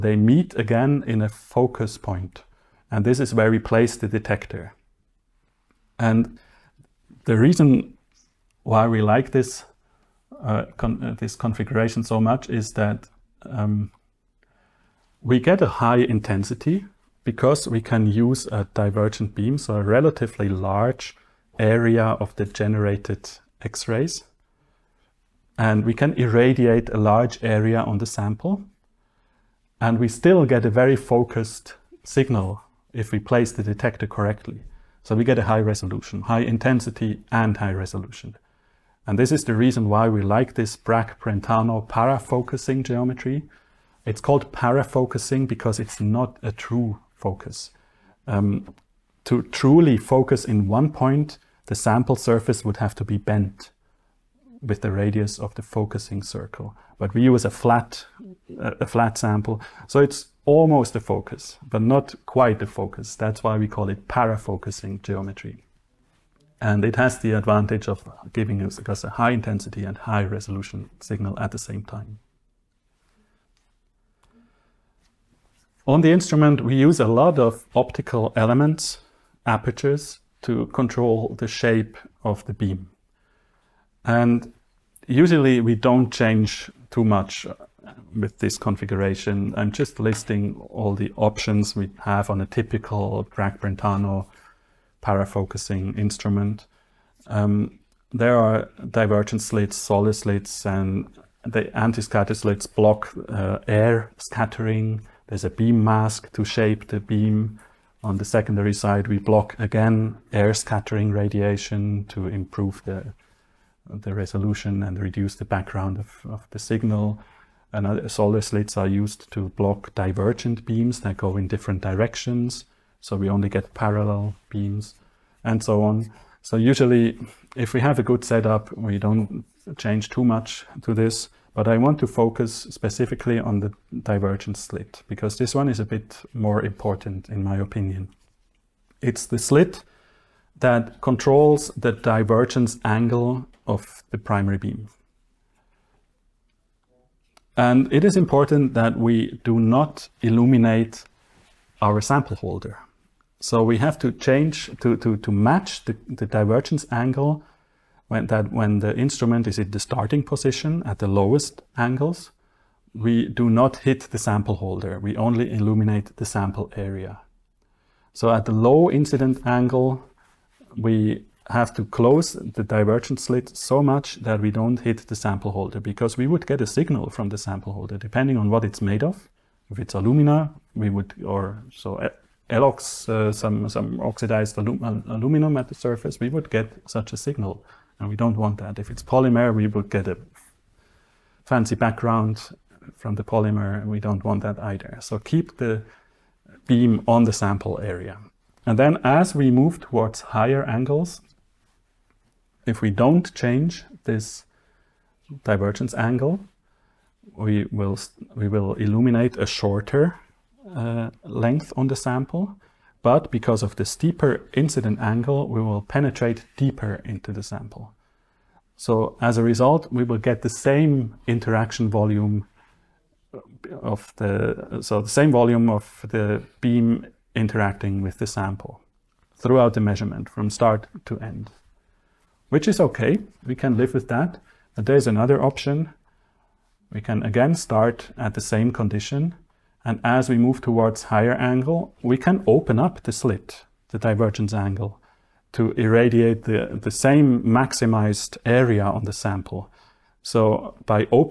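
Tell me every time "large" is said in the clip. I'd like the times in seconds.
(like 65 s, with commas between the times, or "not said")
20 s, 26 s.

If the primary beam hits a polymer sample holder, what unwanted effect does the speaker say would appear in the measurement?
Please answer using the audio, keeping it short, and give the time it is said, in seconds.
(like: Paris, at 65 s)
a fancy background, at 191 s.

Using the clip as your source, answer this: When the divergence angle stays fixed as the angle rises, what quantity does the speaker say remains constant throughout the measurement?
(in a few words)
interaction volume.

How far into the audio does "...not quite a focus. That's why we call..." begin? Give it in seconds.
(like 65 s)
61 s.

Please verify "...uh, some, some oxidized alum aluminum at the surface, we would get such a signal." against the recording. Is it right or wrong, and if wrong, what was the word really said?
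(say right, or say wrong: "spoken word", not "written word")
right.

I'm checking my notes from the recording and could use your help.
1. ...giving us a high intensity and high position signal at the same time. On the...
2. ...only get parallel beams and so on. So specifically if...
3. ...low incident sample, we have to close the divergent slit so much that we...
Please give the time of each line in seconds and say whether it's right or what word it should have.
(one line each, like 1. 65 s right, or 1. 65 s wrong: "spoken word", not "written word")
1. 68 s wrong: "resolution", not "position"
2. 123 s wrong: "usually", not "specifically"
3. 168 s wrong: "angle", not "sample".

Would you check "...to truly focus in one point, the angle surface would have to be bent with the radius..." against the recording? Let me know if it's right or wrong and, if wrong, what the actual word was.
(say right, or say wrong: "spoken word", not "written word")
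wrong: "sample", not "angle".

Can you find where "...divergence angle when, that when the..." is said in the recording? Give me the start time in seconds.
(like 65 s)
156 s.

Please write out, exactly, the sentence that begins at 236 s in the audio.
We can again start at the same condition.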